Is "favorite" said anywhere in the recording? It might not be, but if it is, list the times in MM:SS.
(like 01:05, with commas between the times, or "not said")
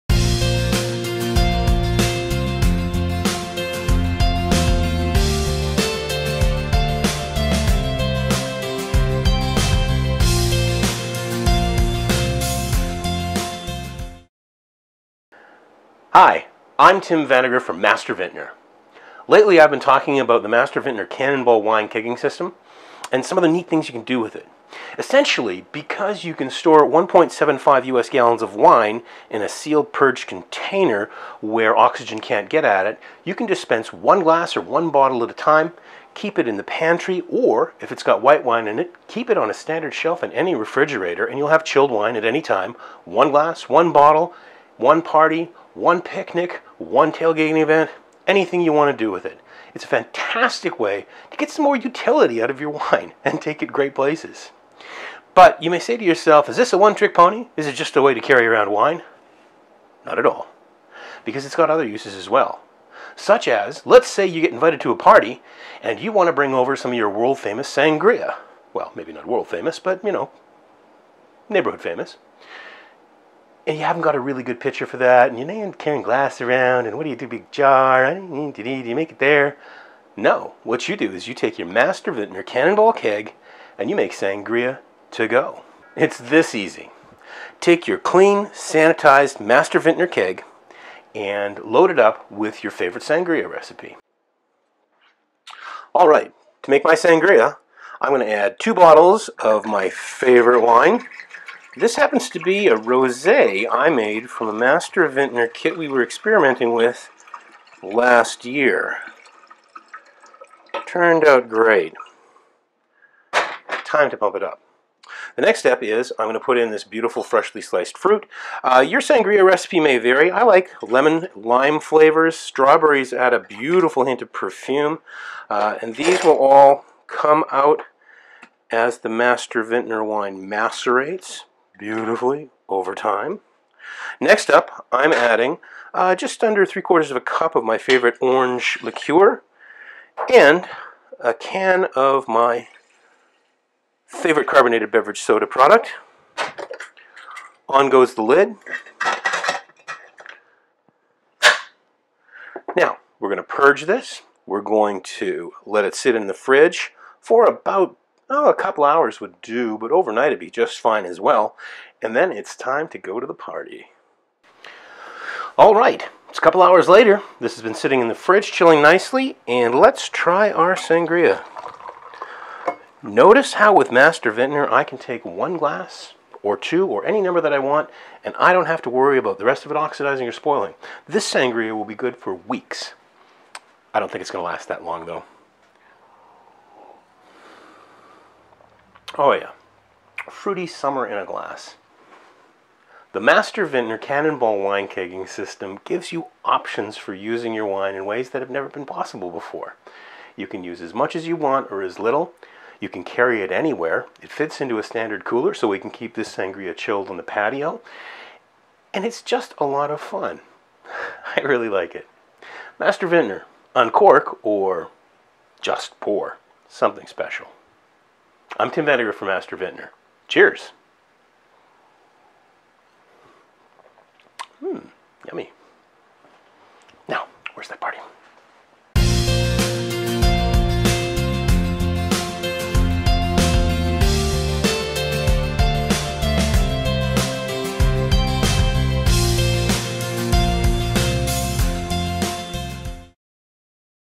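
01:32, 01:39, 02:17, 02:24.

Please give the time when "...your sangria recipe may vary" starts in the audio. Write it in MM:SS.
01:58.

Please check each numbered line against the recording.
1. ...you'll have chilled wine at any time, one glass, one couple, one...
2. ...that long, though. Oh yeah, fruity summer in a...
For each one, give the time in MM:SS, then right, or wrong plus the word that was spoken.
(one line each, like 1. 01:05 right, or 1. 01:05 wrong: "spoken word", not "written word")
1. 00:41 wrong: "bottle", not "couple"
2. 03:04 right.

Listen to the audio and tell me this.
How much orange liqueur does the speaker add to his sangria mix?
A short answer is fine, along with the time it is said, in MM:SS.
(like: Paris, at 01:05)
just under three quarters of a cup, at 02:16.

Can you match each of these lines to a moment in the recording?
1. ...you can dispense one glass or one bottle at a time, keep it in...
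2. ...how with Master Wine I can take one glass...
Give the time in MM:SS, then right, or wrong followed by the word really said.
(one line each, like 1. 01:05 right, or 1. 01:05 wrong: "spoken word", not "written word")
1. 00:33 right
2. 02:53 wrong: "Vintner", not "Wine".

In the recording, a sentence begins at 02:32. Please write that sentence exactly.
Now, we're going to purge this.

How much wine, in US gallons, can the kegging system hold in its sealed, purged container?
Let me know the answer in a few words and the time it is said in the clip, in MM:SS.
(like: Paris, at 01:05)
1.75 US gallons, at 00:26.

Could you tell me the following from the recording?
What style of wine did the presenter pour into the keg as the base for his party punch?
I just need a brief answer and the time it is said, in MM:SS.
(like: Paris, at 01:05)
rosé, at 01:42.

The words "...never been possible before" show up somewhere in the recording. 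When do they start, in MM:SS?
03:18.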